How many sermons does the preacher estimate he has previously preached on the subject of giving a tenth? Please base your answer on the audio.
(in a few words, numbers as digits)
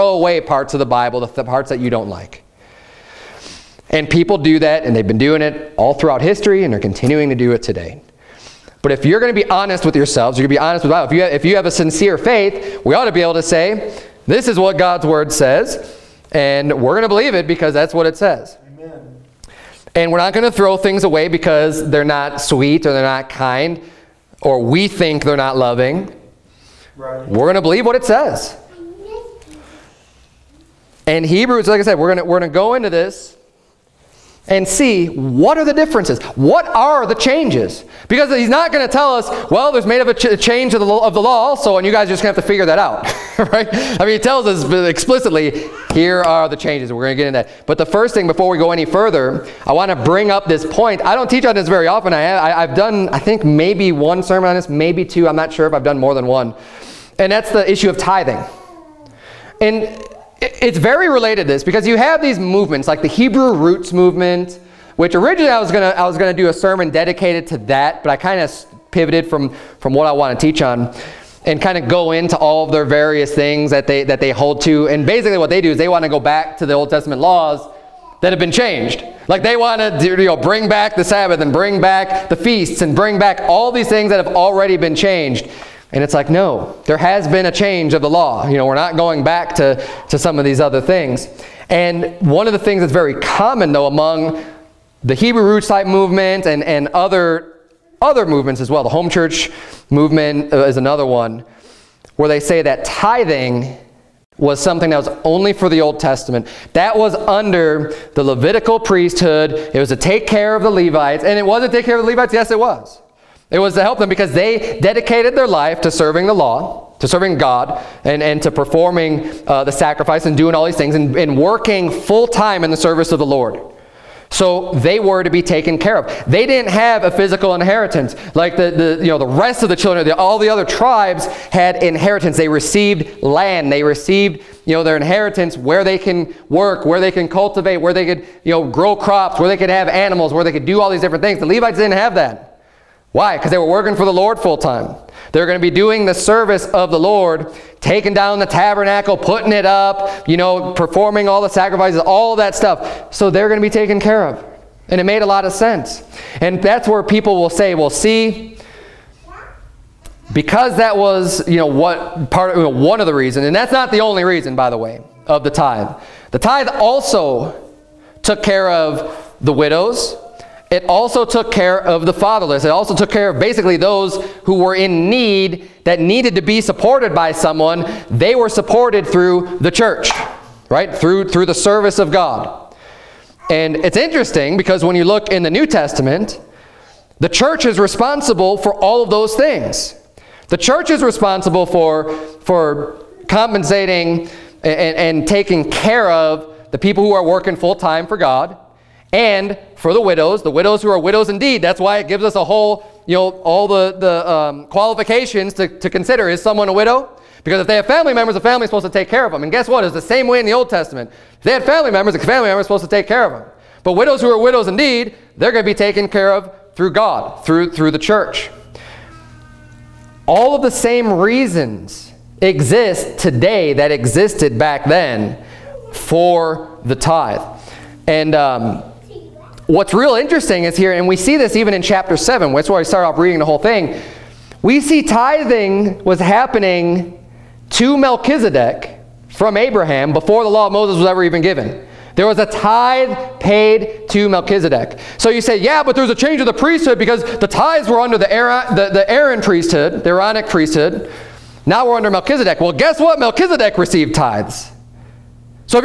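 1 or 2.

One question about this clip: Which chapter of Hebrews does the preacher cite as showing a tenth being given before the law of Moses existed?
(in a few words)
chapter 7.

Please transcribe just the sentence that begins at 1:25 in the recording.
And it's like, no, there has been a change of the law.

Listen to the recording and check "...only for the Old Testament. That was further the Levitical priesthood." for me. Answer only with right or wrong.
wrong.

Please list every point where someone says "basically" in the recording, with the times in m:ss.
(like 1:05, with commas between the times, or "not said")
1:15, 2:53.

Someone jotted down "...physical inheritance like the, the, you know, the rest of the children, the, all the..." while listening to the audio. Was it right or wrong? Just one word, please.
right.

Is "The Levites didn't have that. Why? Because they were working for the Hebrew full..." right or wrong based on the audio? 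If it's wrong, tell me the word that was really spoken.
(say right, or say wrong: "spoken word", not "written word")
wrong: "Lord", not "Hebrew".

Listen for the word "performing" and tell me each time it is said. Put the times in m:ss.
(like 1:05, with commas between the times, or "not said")
1:58, 2:30.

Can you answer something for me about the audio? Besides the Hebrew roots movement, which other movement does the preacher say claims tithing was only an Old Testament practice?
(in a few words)
home church movement.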